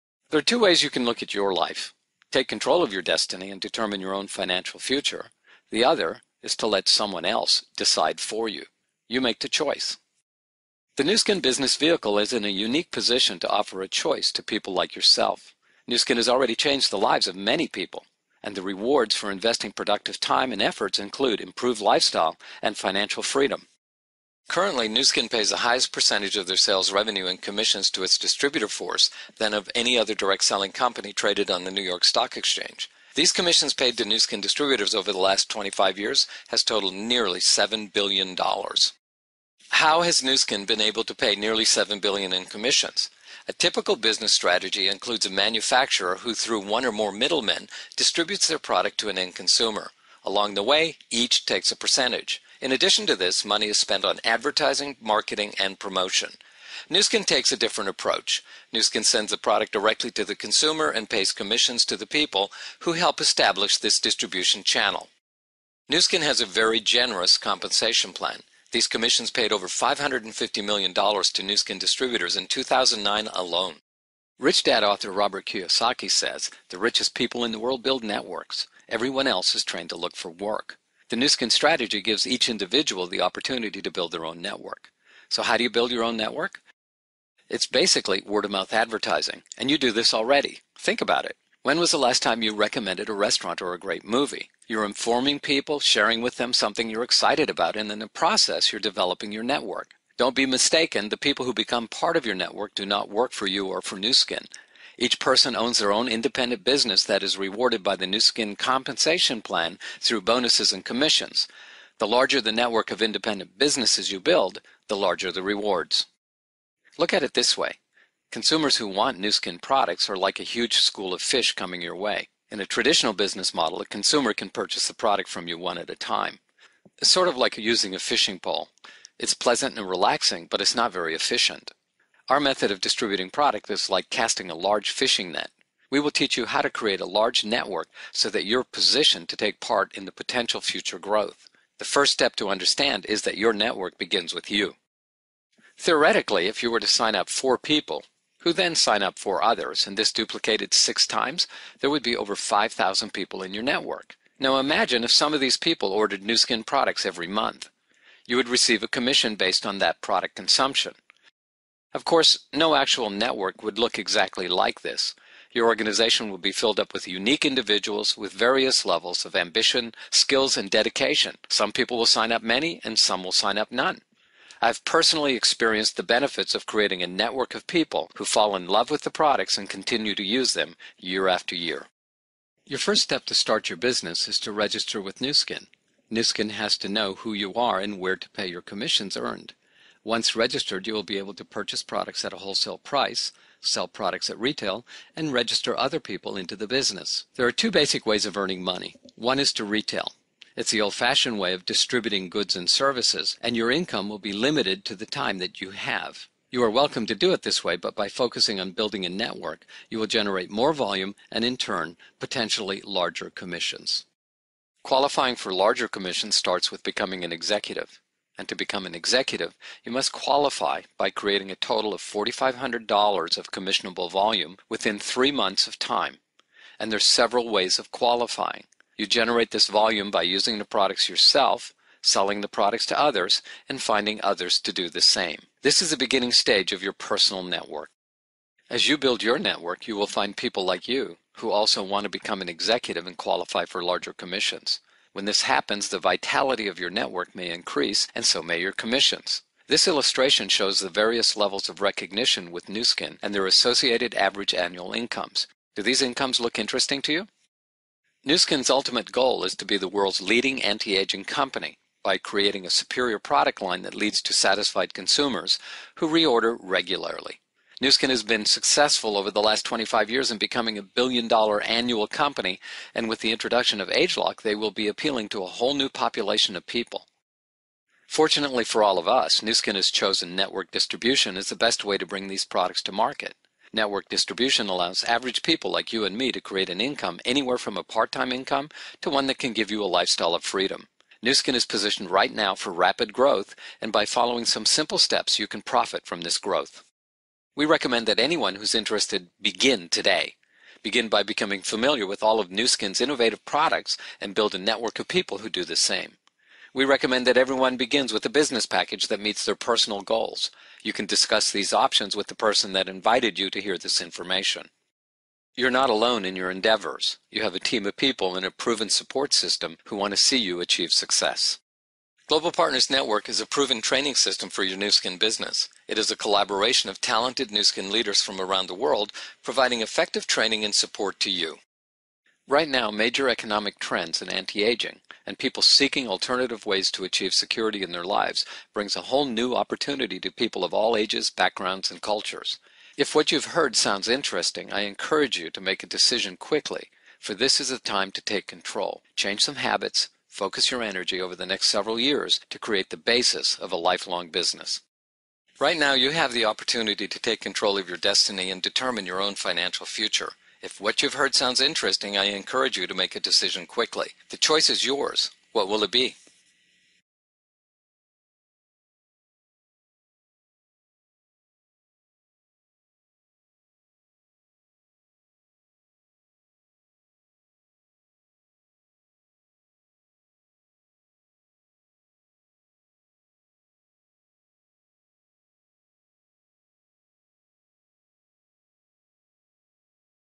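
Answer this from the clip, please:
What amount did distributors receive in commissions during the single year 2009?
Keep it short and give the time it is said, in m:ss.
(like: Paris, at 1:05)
over $550 million, at 1:09.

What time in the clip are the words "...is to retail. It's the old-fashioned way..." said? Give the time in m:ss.
3:19.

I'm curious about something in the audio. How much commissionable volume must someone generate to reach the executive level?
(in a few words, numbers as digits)
$4,500.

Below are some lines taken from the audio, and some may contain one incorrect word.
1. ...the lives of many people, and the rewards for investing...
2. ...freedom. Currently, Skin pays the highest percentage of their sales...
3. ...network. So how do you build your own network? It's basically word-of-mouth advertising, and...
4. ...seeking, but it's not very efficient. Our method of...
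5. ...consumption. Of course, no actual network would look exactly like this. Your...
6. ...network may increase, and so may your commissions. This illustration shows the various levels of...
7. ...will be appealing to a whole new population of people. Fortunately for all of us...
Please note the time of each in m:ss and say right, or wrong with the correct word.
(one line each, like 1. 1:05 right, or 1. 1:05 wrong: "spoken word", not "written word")
1. 0:16 right
2. 0:23 right
3. 1:24 right
4. 2:09 wrong: "relaxing", not "seeking"
5. 2:40 right
6. 4:06 right
7. 4:34 right.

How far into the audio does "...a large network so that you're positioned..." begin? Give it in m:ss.
2:17.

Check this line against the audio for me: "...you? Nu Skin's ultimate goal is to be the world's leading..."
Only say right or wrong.
right.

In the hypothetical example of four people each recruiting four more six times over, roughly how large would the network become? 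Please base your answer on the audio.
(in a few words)
over 5,000 people.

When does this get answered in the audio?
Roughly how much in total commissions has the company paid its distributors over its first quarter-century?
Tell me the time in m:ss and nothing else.
0:41.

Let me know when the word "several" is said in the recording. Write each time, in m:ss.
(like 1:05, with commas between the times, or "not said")
3:47, 5:51.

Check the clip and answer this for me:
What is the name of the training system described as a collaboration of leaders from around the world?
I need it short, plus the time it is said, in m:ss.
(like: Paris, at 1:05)
Global Partners Network, at 5:22.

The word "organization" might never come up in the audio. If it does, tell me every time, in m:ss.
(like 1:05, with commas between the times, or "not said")
2:45.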